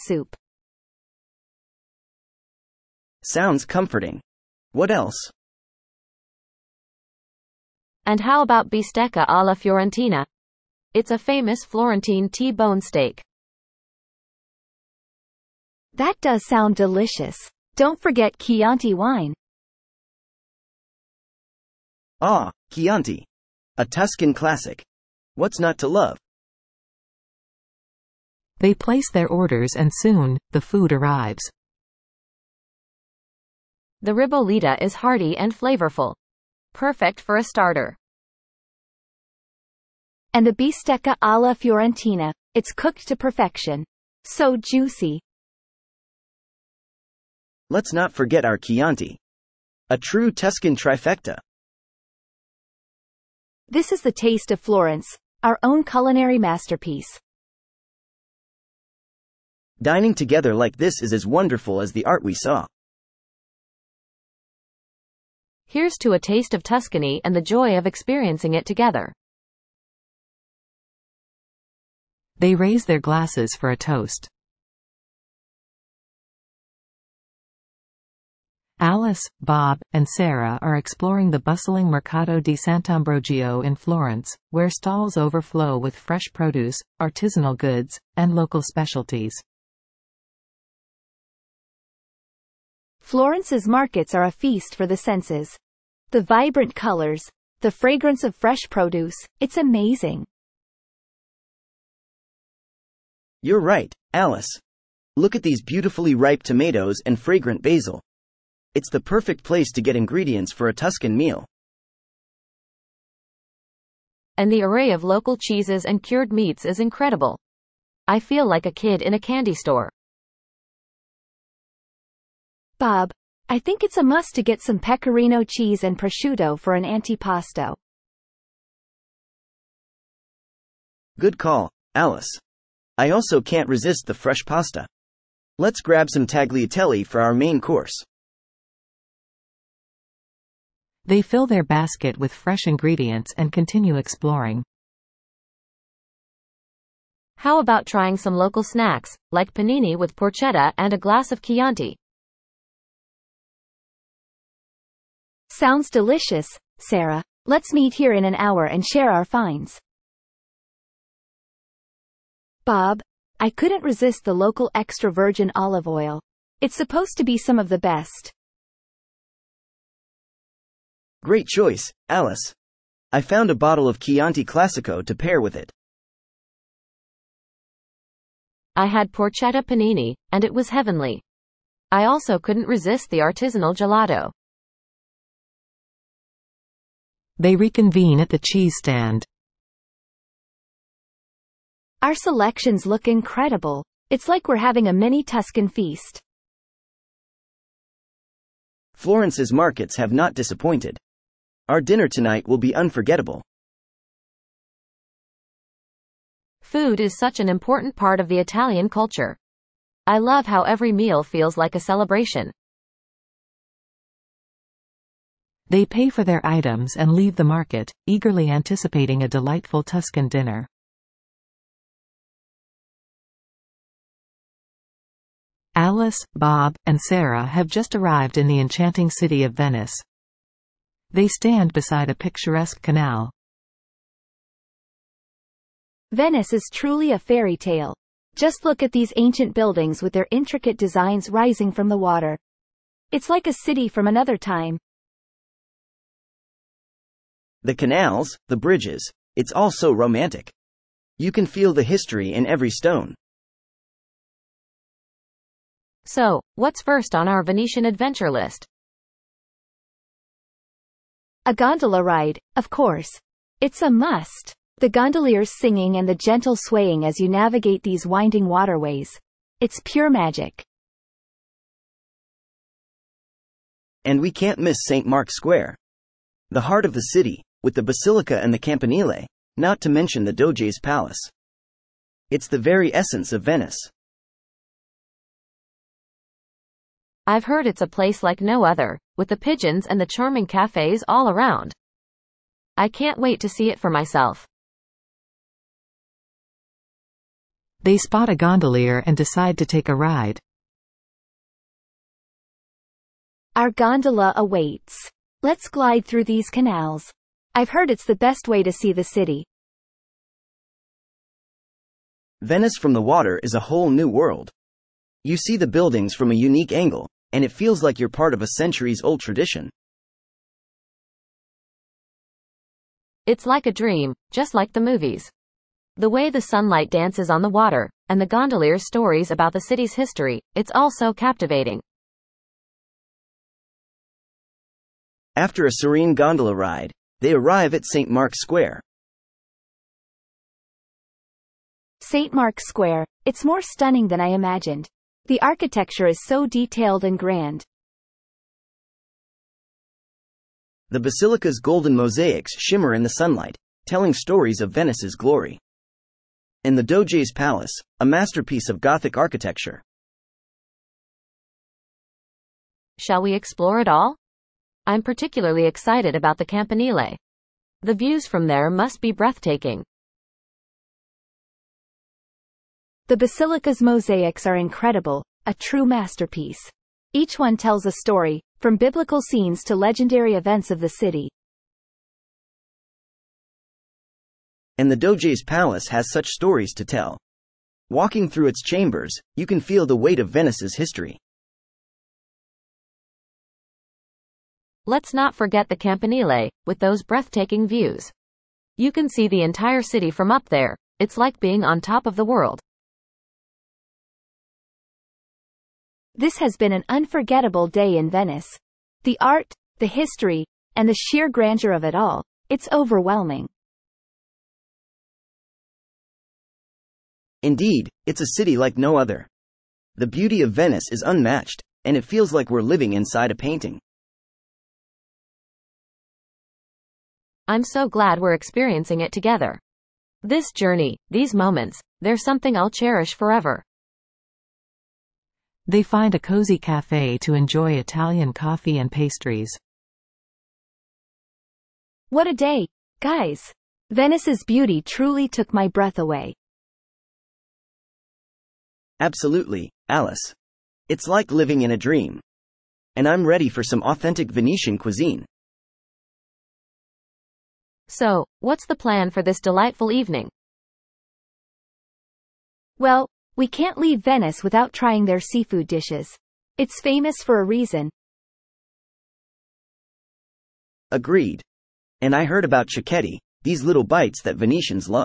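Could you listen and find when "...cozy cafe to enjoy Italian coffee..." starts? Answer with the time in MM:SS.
07:16.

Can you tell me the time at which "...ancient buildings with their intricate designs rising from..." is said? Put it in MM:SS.
03:59.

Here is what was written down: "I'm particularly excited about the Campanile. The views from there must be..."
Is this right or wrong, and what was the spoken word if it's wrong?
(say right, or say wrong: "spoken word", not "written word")
right.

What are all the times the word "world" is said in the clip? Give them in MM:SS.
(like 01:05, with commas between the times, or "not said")
05:14, 06:42.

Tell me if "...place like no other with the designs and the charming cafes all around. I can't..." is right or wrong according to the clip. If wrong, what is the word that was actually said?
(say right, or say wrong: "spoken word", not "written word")
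wrong: "pigeons", not "designs".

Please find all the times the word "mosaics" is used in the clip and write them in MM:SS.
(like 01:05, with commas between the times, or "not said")
05:51, 06:13.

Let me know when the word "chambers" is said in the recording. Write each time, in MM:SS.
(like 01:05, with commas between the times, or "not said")
06:28.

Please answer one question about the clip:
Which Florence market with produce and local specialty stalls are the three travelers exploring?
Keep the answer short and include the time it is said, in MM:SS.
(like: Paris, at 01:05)
Mercato di Sant'Ambrogio, at 01:21.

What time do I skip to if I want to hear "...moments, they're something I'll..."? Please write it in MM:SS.
07:11.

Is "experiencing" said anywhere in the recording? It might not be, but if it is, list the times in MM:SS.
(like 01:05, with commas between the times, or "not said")
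01:07, 07:08.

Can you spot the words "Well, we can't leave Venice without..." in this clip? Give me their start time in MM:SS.
07:42.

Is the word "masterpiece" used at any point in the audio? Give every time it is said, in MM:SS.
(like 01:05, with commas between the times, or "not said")
00:56, 05:58, 06:15.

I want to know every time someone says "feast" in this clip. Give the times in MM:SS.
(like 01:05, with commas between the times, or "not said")
01:34, 03:15.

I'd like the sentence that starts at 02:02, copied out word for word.
Bob, I think it's a must to get some pecorino cheese and prosciutto for an antipasto.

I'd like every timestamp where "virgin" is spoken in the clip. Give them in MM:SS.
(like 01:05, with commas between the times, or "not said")
02:45.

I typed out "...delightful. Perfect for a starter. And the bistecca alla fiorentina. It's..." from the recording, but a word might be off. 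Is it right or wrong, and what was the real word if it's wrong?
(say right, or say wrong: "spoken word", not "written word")
wrong: "flavorful", not "delightful".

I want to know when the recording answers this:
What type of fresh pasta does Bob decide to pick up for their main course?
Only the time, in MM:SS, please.
02:16.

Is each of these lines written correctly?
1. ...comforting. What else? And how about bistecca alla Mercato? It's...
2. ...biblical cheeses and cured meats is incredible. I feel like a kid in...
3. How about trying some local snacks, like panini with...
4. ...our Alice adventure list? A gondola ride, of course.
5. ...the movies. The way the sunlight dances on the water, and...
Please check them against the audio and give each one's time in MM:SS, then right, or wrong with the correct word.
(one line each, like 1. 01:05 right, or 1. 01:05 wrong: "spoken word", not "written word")
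1. 00:03 wrong: "Fiorentina", not "Mercato"
2. 01:55 wrong: "local", not "biblical"
3. 02:27 right
4. 04:17 wrong: "Venetian", not "Alice"
5. 05:24 right.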